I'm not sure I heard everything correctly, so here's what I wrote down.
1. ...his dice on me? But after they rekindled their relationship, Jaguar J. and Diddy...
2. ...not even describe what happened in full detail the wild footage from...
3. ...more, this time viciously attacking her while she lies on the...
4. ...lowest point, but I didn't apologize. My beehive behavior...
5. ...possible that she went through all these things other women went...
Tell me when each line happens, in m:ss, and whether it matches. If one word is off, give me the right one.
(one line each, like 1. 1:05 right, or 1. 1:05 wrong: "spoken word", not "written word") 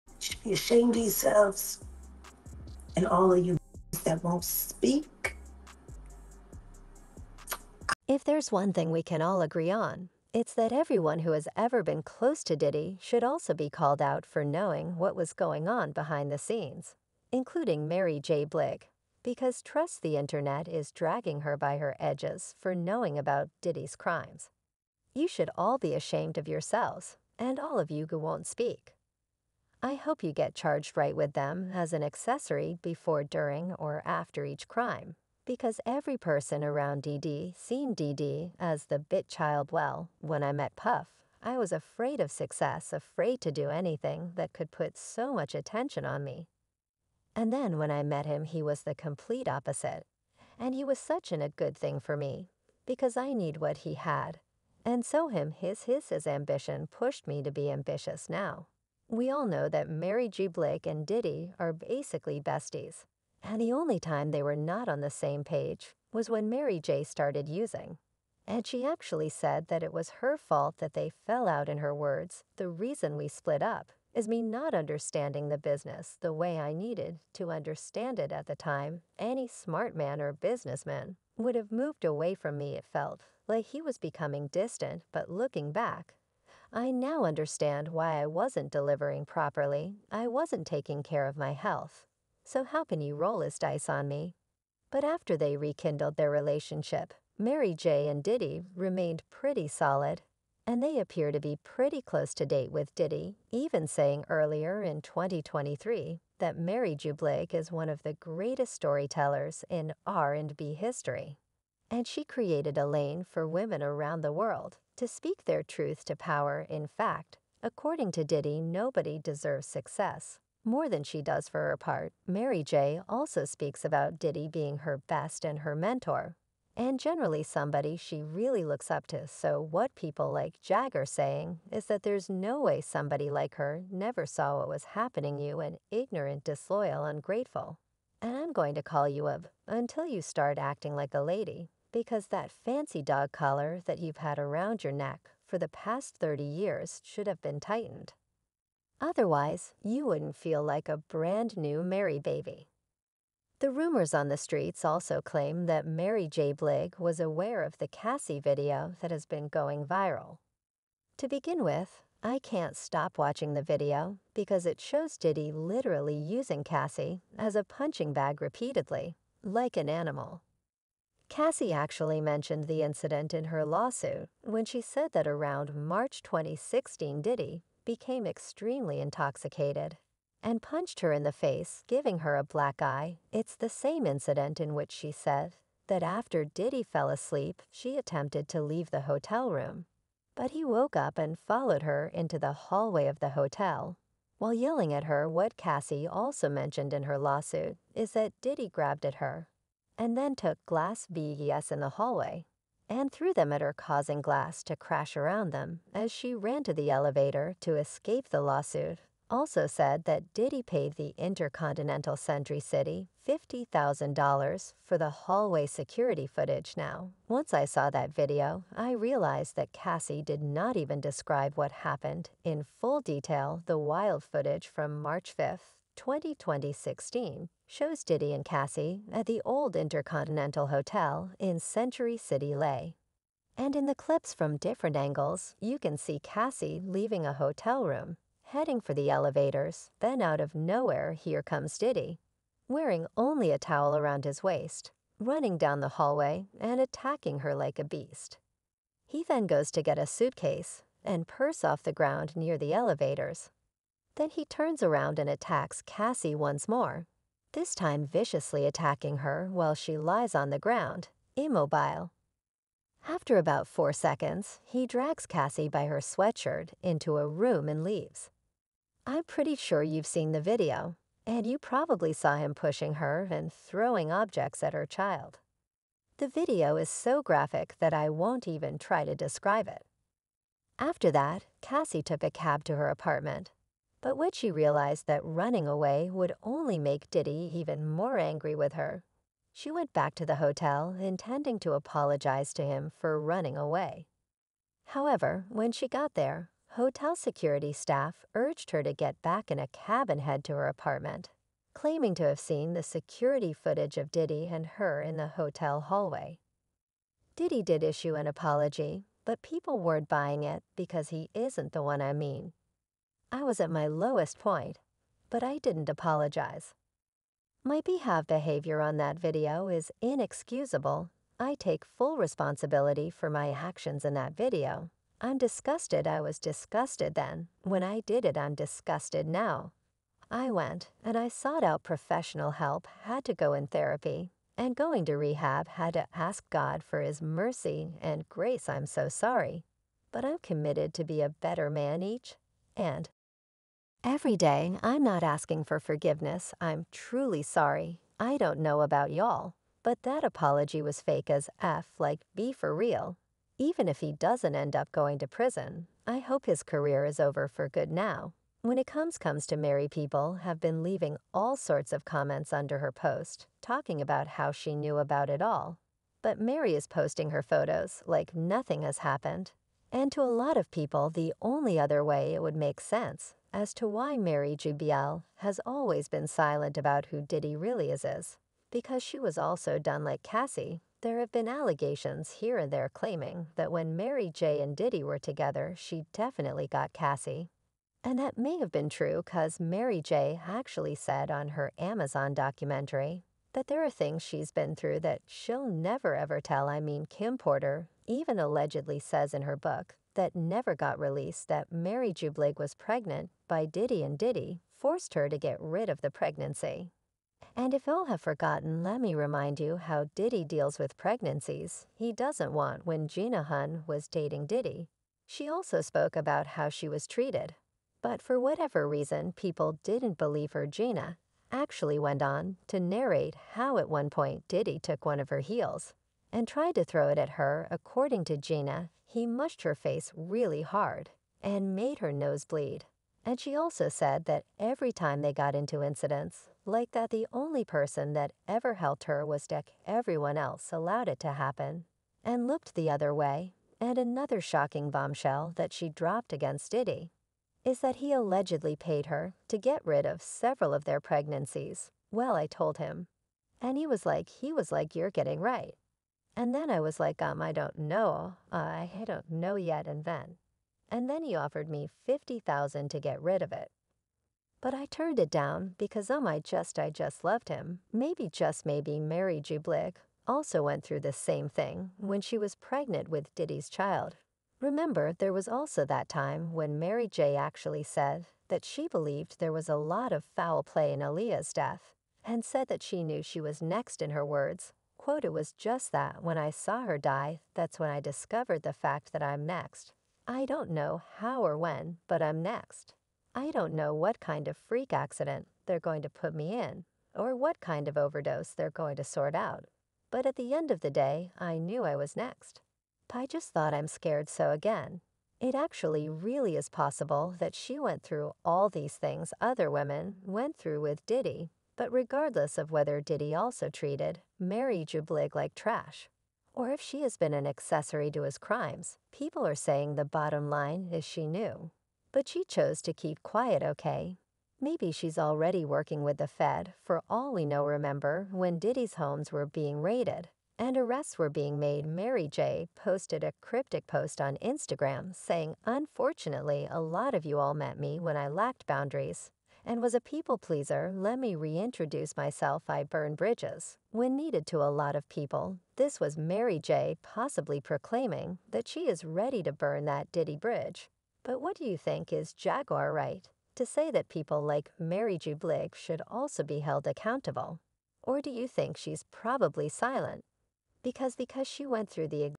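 1. 1:33 wrong: "Mary", not "Jaguar"
2. 3:40 right
3. 4:16 right
4. 5:13 right
5. 8:26 right.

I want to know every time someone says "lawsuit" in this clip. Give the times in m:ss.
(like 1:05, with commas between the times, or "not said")
2:53, 3:17, 3:28.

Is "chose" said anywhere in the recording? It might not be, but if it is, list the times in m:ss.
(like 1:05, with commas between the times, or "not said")
8:42.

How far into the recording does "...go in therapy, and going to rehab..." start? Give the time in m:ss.
5:33.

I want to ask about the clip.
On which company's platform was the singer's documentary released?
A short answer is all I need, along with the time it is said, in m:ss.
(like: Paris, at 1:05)
Amazon, at 6:31.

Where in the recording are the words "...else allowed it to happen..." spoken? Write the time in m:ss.
7:20.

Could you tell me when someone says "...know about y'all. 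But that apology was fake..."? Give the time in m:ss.
5:48.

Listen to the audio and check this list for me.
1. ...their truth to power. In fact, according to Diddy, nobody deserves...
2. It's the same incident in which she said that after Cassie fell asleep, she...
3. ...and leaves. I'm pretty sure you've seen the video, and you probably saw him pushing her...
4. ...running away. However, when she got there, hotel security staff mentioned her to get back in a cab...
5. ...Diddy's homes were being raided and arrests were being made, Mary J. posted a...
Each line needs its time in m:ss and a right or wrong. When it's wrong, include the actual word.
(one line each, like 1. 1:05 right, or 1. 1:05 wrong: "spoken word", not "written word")
1. 1:55 right
2. 3:03 wrong: "Diddy", not "Cassie"
3. 4:27 right
4. 4:53 wrong: "urged", not "mentioned"
5. 8:48 right.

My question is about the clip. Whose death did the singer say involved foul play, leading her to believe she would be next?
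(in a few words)
Aaliyah.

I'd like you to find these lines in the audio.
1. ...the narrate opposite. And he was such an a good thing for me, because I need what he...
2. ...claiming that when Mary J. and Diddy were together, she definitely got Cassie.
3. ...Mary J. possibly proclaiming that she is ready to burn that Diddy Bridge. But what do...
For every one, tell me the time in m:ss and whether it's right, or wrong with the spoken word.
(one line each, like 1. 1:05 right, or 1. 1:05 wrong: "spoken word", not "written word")
1. 0:48 wrong: "complete", not "narrate"
2. 6:22 right
3. 9:06 right.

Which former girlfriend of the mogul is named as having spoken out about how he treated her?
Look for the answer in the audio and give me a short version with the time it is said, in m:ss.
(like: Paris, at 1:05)
Gina Huynh, at 6:53.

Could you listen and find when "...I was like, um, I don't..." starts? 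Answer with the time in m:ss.
7:36.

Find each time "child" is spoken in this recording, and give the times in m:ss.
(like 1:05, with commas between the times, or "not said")
0:39, 4:34, 7:53.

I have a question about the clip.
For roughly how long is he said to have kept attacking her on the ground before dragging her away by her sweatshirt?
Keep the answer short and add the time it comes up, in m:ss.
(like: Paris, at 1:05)
4 seconds, at 4:23.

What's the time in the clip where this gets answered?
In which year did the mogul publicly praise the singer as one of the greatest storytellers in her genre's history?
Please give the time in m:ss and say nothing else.
1:45.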